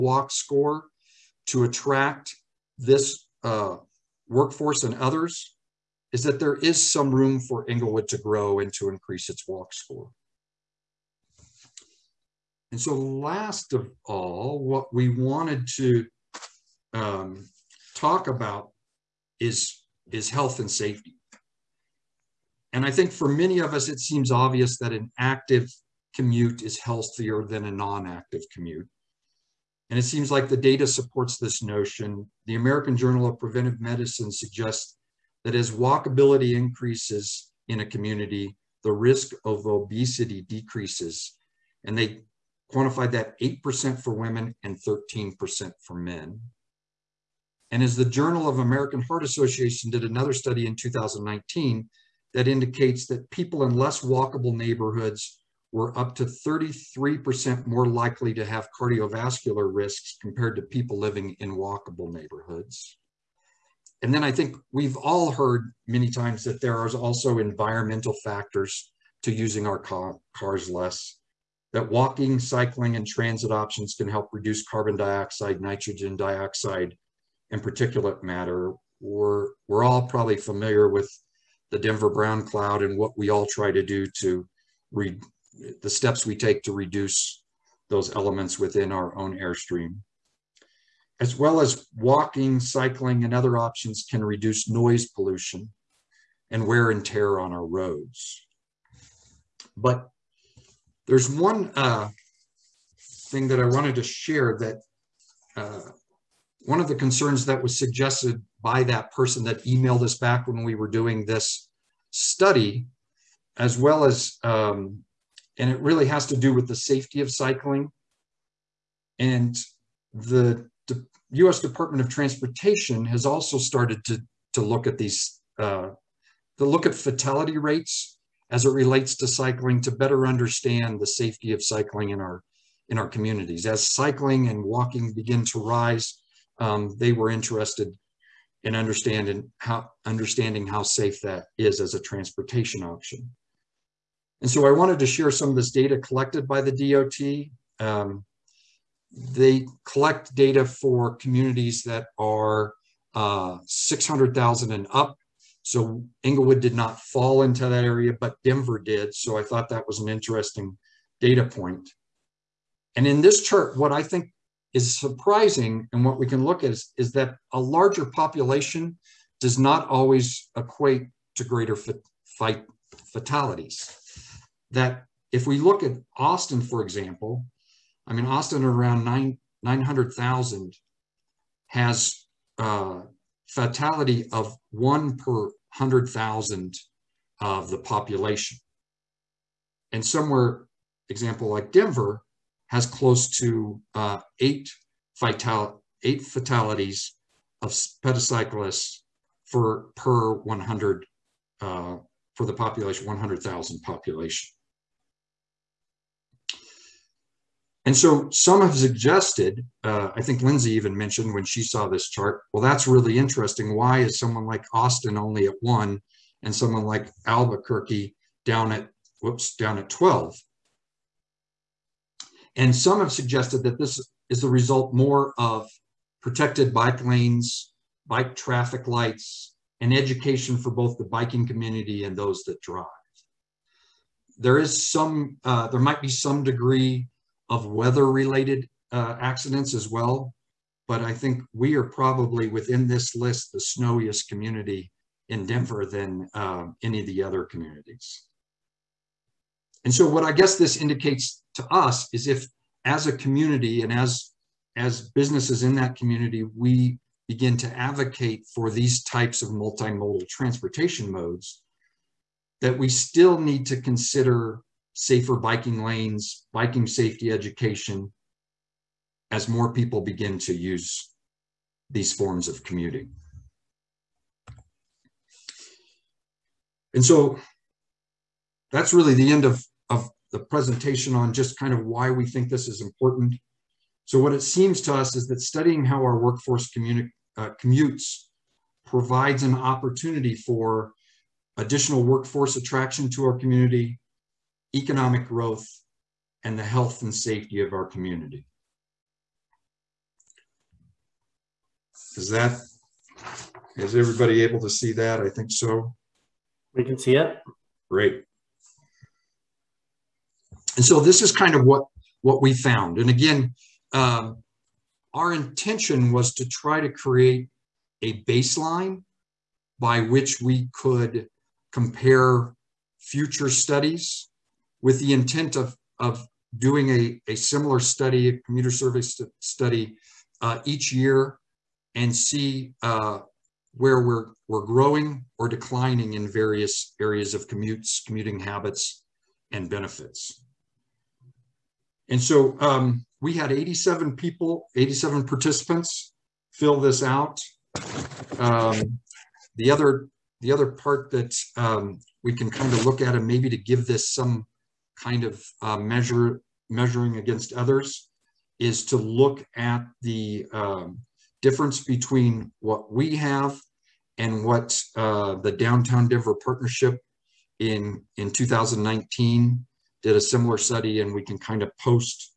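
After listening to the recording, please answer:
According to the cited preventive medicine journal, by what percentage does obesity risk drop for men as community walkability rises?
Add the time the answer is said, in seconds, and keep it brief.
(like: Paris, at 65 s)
13%, at 44 s.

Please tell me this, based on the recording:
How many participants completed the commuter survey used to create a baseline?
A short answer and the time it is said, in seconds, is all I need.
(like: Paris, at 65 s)
87, at 344 s.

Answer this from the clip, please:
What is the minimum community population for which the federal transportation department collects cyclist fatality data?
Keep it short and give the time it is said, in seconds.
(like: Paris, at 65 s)
600,000, at 153 s.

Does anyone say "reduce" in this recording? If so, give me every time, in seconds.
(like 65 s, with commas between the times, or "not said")
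74 s, 86 s, 94 s.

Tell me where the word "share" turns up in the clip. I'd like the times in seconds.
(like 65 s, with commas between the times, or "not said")
104 s, 145 s.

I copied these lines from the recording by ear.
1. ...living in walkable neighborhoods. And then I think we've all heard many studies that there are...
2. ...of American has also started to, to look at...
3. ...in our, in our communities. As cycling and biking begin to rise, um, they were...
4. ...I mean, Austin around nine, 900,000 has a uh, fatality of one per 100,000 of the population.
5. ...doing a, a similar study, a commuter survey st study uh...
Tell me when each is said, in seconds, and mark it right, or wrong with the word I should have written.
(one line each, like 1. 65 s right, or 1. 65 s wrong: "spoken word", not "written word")
1. 60 s wrong: "times", not "studies"
2. 122 s wrong: "Transportation", not "American"
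3. 132 s wrong: "walking", not "biking"
4. 178 s right
5. 326 s right.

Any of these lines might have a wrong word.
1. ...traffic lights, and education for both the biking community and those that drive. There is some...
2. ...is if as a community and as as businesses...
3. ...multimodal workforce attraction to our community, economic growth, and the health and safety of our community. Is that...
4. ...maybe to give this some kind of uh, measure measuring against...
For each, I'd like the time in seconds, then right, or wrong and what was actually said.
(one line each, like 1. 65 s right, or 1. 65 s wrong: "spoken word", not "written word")
1. 228 s right
2. 252 s right
3. 291 s wrong: "additional", not "multimodal"
4. 353 s right.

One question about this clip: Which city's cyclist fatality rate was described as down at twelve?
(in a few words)
Albuquerque.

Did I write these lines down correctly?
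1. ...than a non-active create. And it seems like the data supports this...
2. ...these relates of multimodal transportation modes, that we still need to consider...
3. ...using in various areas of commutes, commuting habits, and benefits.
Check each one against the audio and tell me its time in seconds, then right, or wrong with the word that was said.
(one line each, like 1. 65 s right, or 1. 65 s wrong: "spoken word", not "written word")
1. 27 s wrong: "commute", not "create"
2. 258 s wrong: "types", not "relates"
3. 335 s wrong: "declining", not "using".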